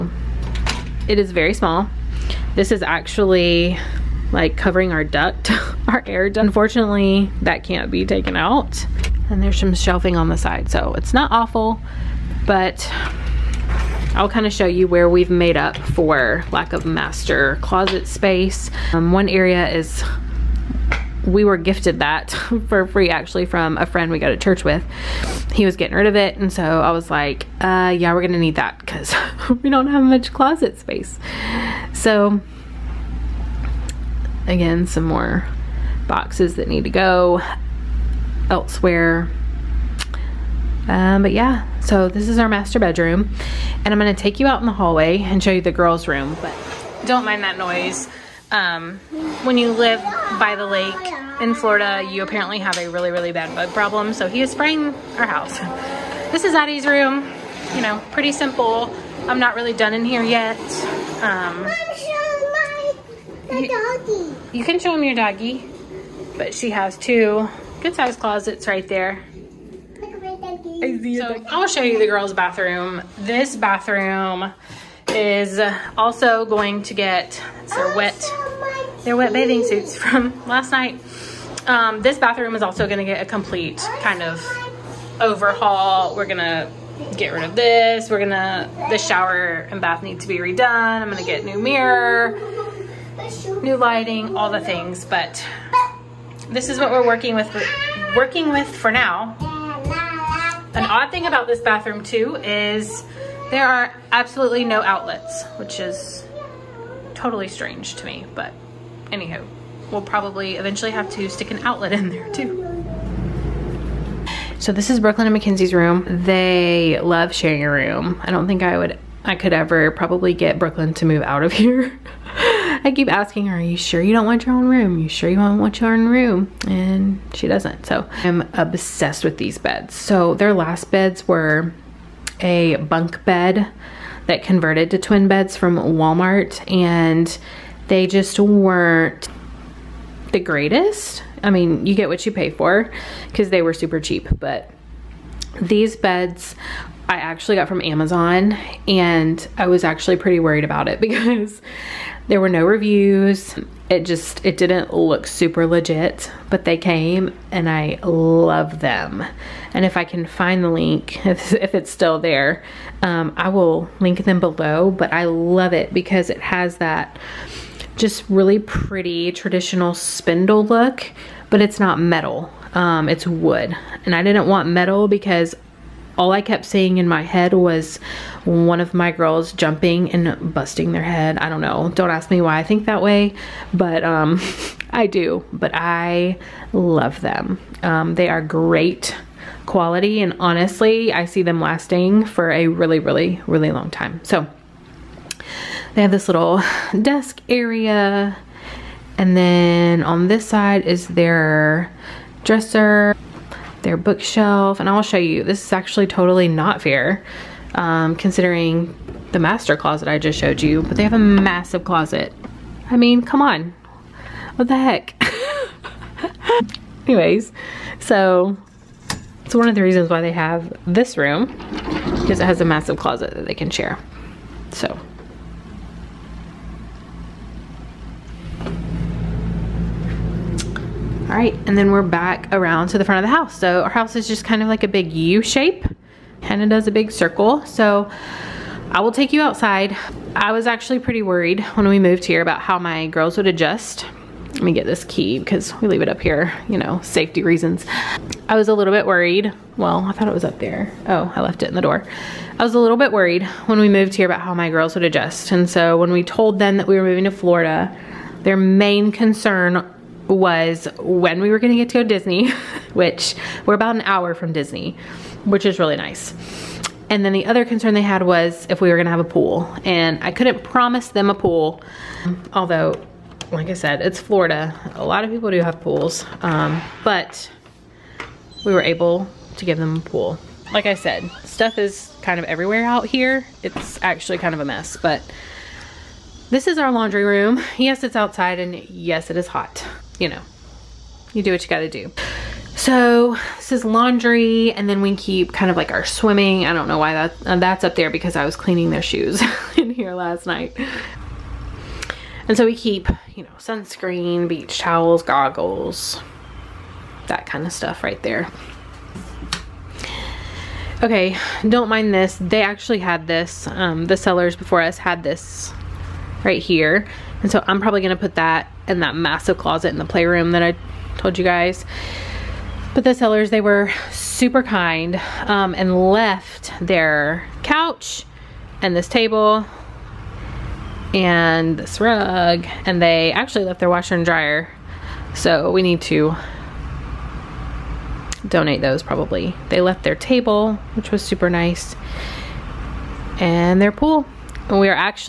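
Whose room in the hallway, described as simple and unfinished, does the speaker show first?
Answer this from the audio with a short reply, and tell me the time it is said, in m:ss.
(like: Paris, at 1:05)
Addie, at 0:56.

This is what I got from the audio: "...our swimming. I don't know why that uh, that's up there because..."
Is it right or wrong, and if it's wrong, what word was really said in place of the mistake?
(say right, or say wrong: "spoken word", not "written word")
right.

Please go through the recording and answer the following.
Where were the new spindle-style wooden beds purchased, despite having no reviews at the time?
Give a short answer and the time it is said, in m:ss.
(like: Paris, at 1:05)
Amazon, at 2:27.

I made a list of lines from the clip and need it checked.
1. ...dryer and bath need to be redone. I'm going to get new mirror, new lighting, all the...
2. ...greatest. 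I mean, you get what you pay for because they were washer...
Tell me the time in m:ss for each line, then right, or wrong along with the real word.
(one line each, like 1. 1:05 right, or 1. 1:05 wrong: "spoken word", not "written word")
1. 1:28 wrong: "shower", not "dryer"
2. 2:20 wrong: "super", not "washer".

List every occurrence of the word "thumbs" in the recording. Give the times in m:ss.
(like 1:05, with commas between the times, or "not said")
not said.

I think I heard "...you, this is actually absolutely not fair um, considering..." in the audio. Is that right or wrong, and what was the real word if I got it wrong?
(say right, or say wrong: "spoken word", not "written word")
wrong: "totally", not "absolutely".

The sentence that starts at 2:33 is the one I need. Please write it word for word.
It just, it didn't look super legit, but they came and I love them.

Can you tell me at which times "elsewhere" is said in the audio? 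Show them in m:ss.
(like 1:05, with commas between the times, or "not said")
0:38.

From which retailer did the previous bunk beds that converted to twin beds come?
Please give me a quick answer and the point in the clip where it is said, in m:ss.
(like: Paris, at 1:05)
Walmart, at 2:15.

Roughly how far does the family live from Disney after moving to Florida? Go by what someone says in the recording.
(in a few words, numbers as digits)
About an hour.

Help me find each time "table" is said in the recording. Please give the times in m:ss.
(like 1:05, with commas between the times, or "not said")
5:29, 5:40.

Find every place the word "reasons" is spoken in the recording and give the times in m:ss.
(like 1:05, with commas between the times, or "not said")
3:39, 4:07.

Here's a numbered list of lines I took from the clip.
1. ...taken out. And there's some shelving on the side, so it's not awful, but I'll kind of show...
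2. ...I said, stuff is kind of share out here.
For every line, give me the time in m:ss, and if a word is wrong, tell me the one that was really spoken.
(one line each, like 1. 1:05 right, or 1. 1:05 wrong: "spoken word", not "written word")
1. 0:08 right
2. 4:40 wrong: "everywhere", not "share".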